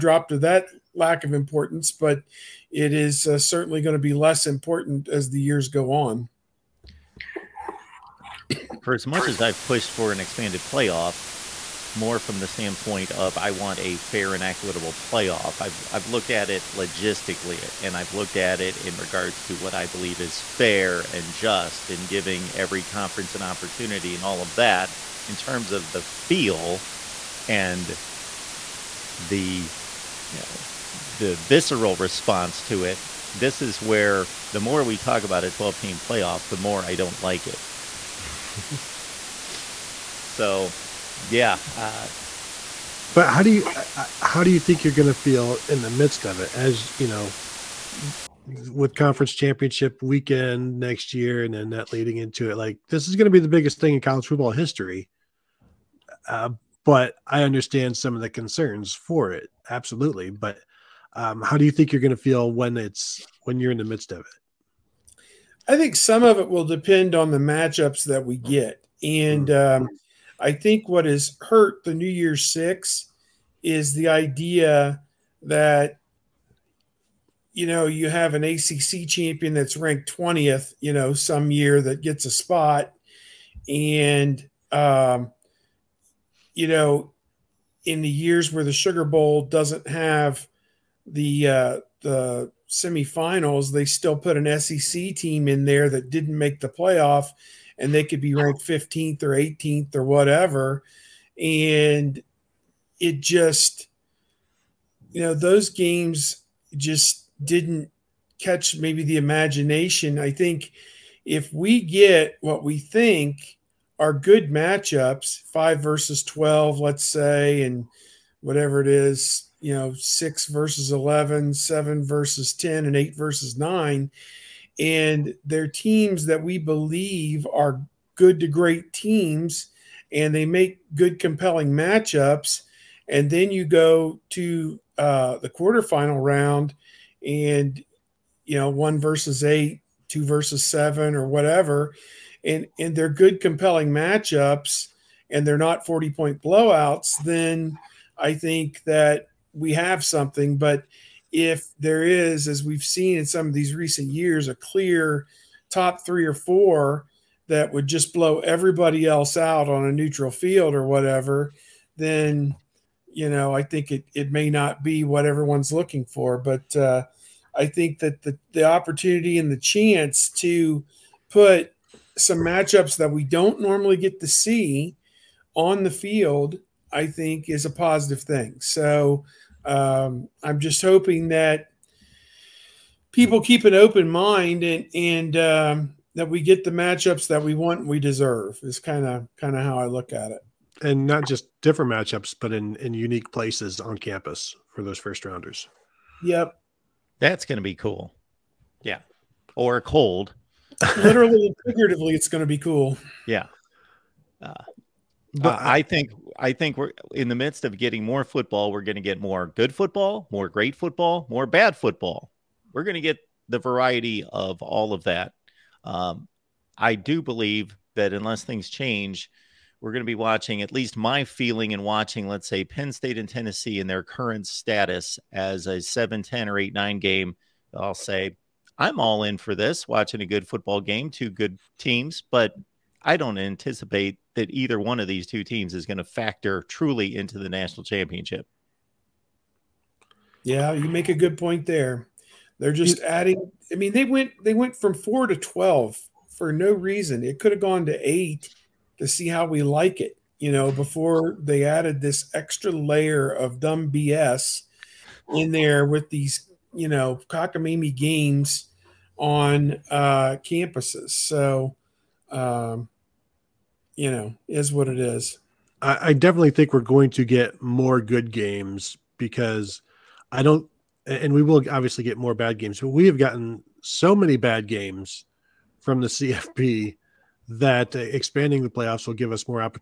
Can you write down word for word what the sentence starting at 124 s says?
And they're teams that we believe are good to great teams and they make good, compelling matchups.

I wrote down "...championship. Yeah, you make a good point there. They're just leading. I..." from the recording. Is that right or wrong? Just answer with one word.
wrong.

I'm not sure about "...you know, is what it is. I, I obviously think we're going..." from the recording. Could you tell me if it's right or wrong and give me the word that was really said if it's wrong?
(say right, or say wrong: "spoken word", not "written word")
wrong: "definitely", not "obviously".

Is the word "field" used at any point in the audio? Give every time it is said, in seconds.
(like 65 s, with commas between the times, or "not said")
160 s, 175 s.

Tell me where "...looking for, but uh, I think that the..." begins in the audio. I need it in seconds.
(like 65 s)
165 s.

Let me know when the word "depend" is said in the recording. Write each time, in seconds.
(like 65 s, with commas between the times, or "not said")
66 s.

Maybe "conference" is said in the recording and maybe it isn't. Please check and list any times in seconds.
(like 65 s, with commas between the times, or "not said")
22 s, 48 s.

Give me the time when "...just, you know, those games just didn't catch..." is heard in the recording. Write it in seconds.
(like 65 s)
103 s.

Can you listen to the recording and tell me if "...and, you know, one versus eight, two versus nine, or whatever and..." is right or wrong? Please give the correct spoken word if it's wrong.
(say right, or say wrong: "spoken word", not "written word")
wrong: "seven", not "nine".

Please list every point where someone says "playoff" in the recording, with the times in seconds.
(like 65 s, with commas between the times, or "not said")
10 s, 14 s, 35 s, 96 s, 278 s.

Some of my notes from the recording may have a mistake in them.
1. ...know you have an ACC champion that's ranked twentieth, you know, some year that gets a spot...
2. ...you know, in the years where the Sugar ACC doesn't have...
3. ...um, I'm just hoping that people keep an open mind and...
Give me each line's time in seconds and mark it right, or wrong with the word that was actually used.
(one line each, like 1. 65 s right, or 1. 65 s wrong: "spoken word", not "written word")
1. 77 s right
2. 86 s wrong: "Bowl", not "ACC"
3. 179 s right.